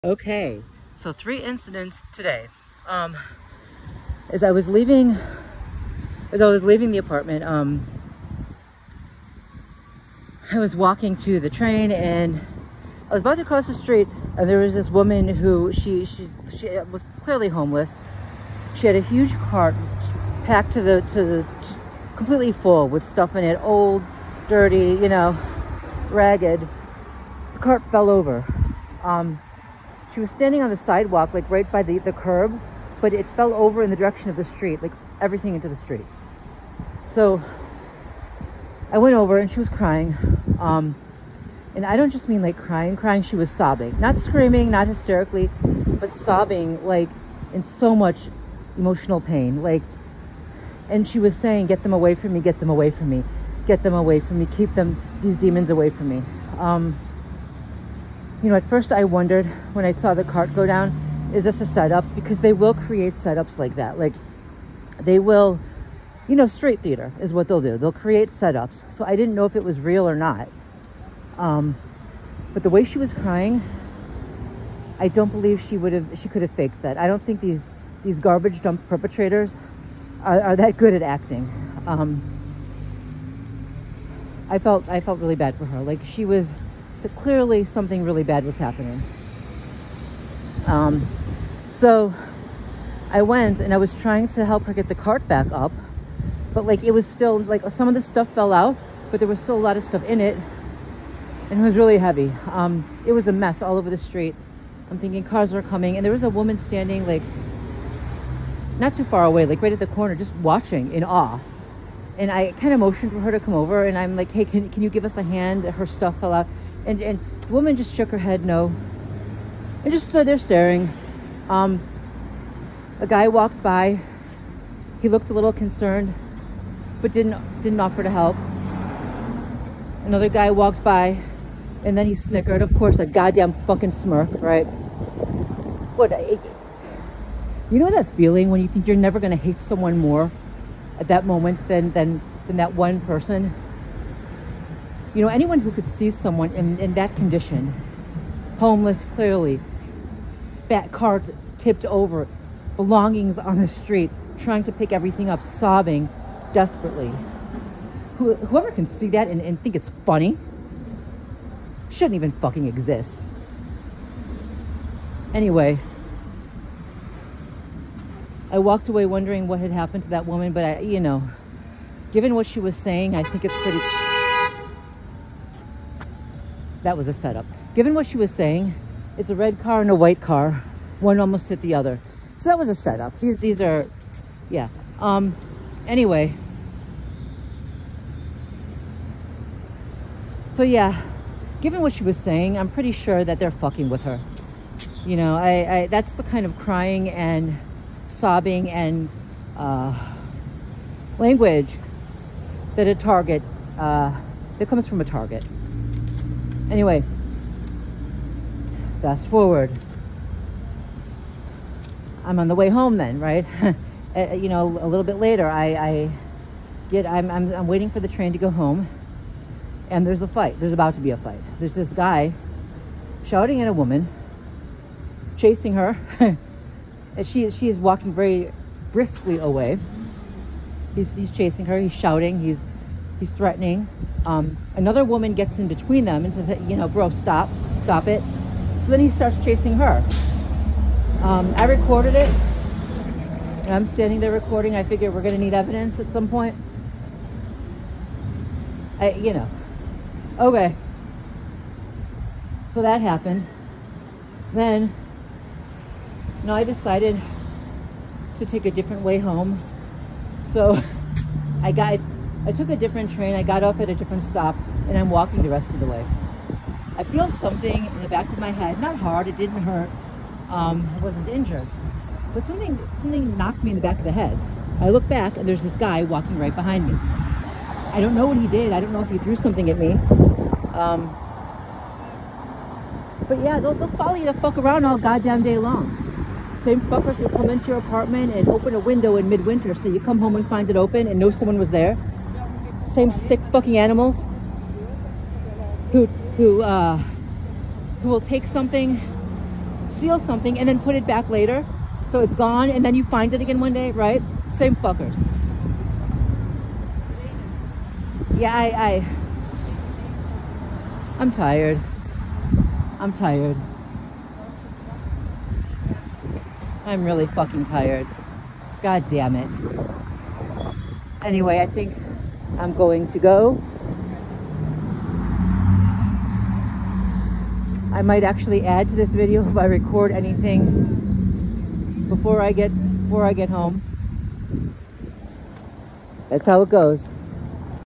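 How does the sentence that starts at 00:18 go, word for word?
She had a huge cart packed to the to the completely full with stuff in it, old, dirty, you know, ragged.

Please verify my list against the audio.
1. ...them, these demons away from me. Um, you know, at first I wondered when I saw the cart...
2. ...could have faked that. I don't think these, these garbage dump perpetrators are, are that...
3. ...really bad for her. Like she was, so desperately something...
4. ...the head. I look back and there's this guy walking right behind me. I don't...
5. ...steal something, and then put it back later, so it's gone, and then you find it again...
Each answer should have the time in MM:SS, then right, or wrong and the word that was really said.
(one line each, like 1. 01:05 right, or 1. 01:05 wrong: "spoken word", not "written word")
1. 00:54 right
2. 01:16 right
3. 01:25 wrong: "clearly", not "desperately"
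4. 04:34 right
5. 04:59 right.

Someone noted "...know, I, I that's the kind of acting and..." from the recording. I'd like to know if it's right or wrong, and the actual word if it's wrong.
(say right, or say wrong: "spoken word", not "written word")
wrong: "crying", not "acting".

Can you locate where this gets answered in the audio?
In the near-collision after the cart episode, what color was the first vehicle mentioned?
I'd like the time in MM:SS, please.
02:59.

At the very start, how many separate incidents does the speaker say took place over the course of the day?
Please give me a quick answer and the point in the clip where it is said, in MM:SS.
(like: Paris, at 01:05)
3, at 00:01.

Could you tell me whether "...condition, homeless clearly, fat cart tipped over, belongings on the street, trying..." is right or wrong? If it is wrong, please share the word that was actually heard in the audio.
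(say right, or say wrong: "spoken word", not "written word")
right.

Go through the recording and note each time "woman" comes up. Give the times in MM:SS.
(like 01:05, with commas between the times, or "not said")
00:14, 01:46, 01:57, 02:50, 03:43, 03:55.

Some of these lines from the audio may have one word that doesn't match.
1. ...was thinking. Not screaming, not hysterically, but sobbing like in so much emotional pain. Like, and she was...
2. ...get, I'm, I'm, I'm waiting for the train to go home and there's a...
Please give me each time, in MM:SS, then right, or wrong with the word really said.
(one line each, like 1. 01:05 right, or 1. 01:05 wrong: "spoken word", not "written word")
1. 00:43 wrong: "sobbing", not "thinking"
2. 03:36 right.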